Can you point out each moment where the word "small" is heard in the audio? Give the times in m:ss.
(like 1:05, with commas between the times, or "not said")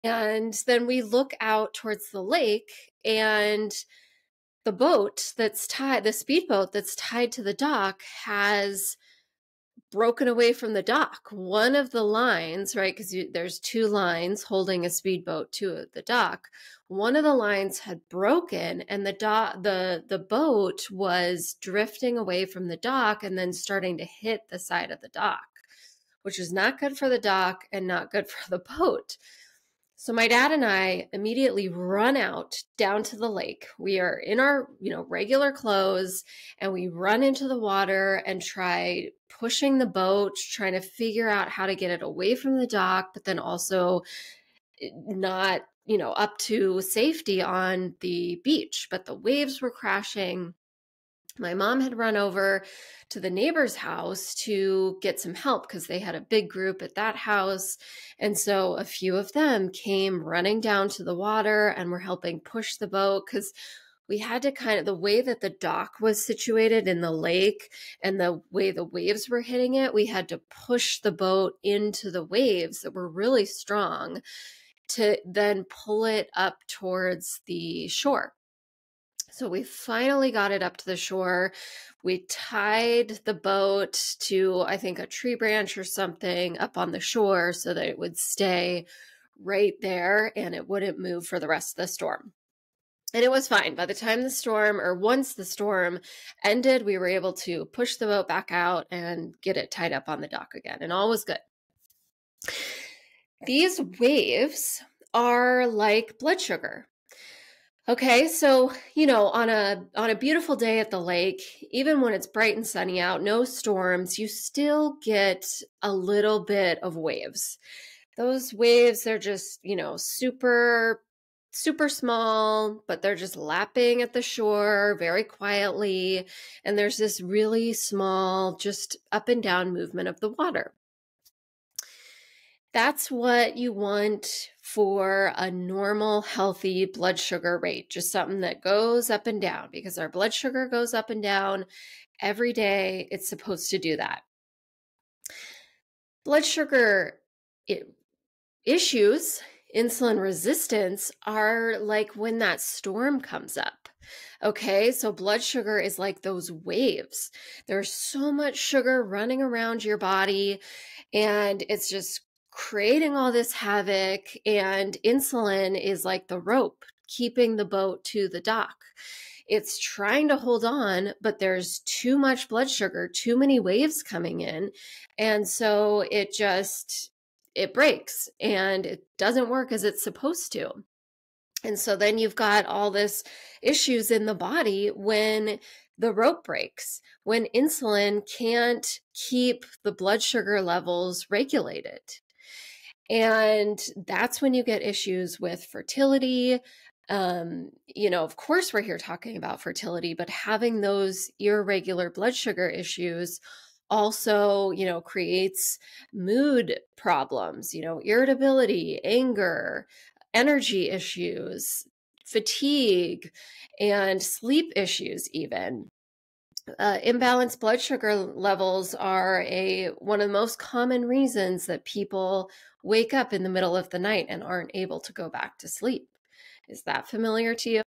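2:01, 2:07.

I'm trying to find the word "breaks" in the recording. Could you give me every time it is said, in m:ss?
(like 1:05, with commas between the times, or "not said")
2:57, 3:06.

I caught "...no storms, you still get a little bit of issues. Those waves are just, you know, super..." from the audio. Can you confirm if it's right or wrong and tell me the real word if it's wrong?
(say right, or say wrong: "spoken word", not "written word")
wrong: "waves", not "issues".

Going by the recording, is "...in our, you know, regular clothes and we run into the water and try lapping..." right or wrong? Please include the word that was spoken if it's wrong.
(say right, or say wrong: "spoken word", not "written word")
wrong: "pushing", not "lapping".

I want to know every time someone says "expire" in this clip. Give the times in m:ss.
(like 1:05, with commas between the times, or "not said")
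not said.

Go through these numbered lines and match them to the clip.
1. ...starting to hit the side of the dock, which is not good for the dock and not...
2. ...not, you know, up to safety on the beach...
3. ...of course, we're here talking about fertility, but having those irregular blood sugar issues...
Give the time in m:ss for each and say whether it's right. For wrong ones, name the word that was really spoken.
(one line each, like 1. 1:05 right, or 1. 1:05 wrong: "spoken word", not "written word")
1. 0:23 right
2. 0:45 right
3. 3:18 right.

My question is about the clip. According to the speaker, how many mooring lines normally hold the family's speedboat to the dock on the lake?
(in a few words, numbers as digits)
2.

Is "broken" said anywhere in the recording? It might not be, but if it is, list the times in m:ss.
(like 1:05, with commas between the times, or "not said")
0:09, 0:18.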